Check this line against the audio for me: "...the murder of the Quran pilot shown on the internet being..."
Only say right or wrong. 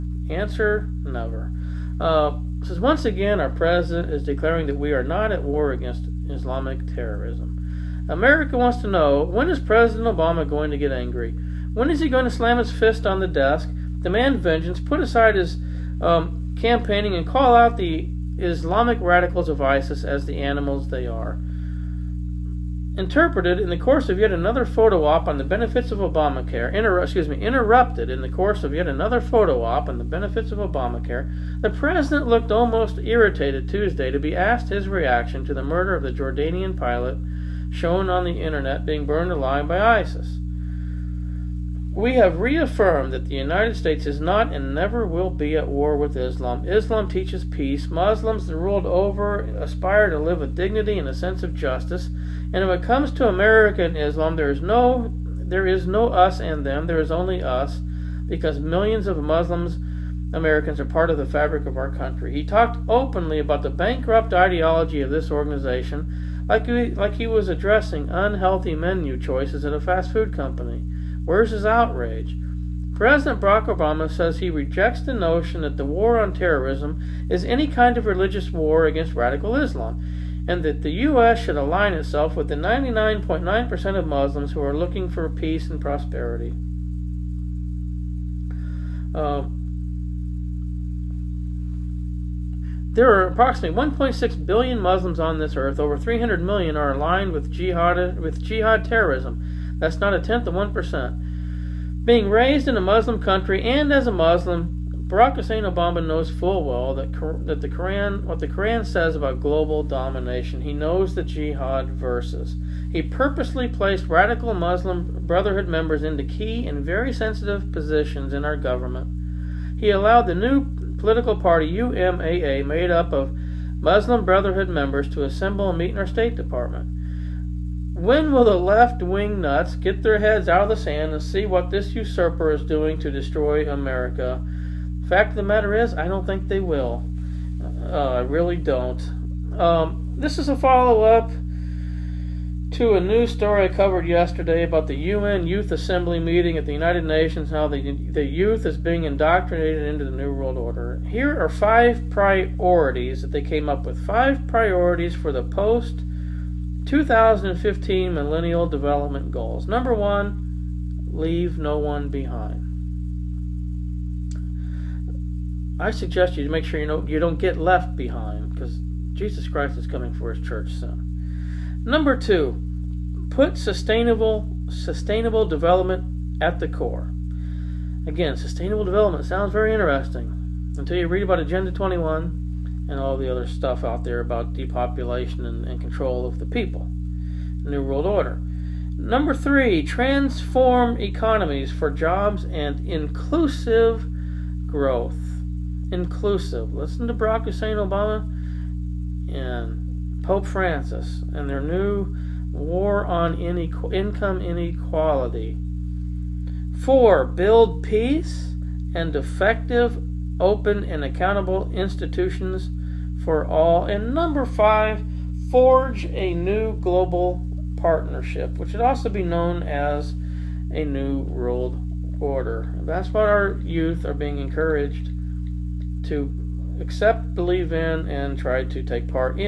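wrong.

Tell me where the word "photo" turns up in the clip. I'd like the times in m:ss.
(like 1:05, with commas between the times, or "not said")
0:24, 0:29.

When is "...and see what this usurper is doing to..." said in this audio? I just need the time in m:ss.
2:11.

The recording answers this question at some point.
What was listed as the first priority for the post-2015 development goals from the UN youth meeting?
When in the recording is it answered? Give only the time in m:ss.
2:41.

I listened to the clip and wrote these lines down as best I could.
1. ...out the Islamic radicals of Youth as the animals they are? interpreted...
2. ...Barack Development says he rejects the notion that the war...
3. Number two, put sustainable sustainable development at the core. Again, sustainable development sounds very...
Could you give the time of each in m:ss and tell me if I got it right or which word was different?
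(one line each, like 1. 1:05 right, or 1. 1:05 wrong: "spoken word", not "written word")
1. 0:17 wrong: "ISIS", not "Youth"
2. 1:13 wrong: "Obama", not "Development"
3. 2:51 right.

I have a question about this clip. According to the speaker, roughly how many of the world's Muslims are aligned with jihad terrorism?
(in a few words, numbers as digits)
300 million.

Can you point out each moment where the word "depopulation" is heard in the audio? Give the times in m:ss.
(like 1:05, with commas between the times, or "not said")
3:04.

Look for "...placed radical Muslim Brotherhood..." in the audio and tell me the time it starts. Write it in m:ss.
1:53.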